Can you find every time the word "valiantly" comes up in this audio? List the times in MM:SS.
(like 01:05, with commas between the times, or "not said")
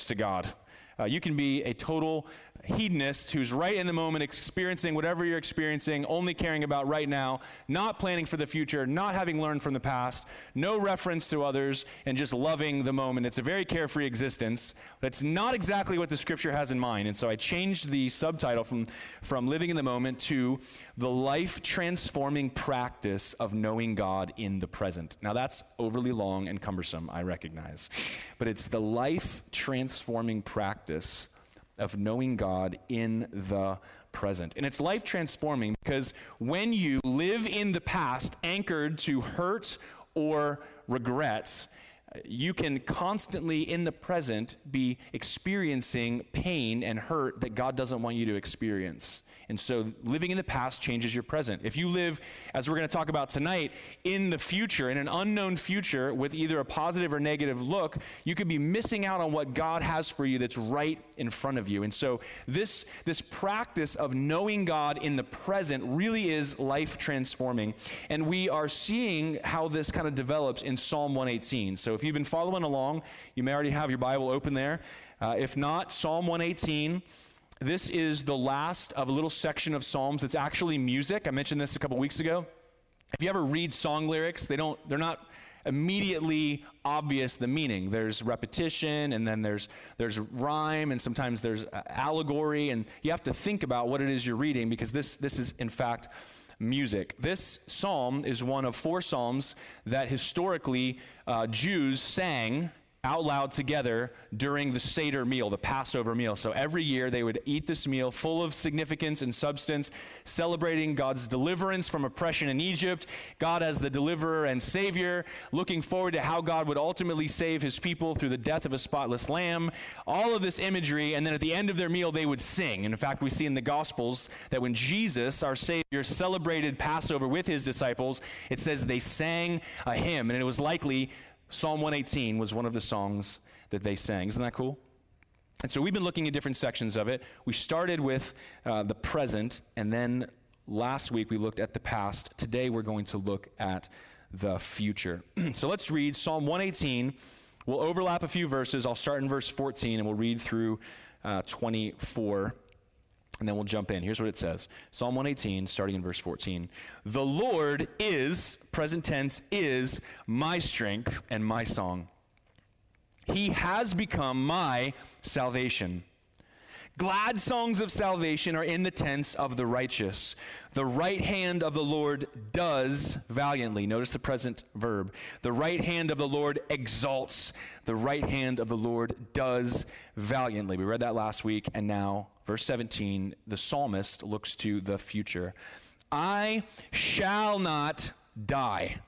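02:53, 03:00.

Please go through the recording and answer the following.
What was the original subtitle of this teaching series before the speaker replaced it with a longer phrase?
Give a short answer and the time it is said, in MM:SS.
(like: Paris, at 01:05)
Living in the Moment, at 00:19.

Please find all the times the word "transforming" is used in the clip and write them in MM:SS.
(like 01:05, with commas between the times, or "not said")
00:21, 00:29, 00:35, 01:06.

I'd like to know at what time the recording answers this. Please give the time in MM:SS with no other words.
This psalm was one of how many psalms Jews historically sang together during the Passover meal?
01:38.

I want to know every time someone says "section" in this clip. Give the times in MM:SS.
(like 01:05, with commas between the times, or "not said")
01:19, 02:16.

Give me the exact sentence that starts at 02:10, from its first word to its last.
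And it was likely Psalm 118 was one of the songs that they sang.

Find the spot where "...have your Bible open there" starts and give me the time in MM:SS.
01:13.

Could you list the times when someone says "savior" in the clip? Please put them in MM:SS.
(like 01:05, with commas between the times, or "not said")
01:54, 02:05.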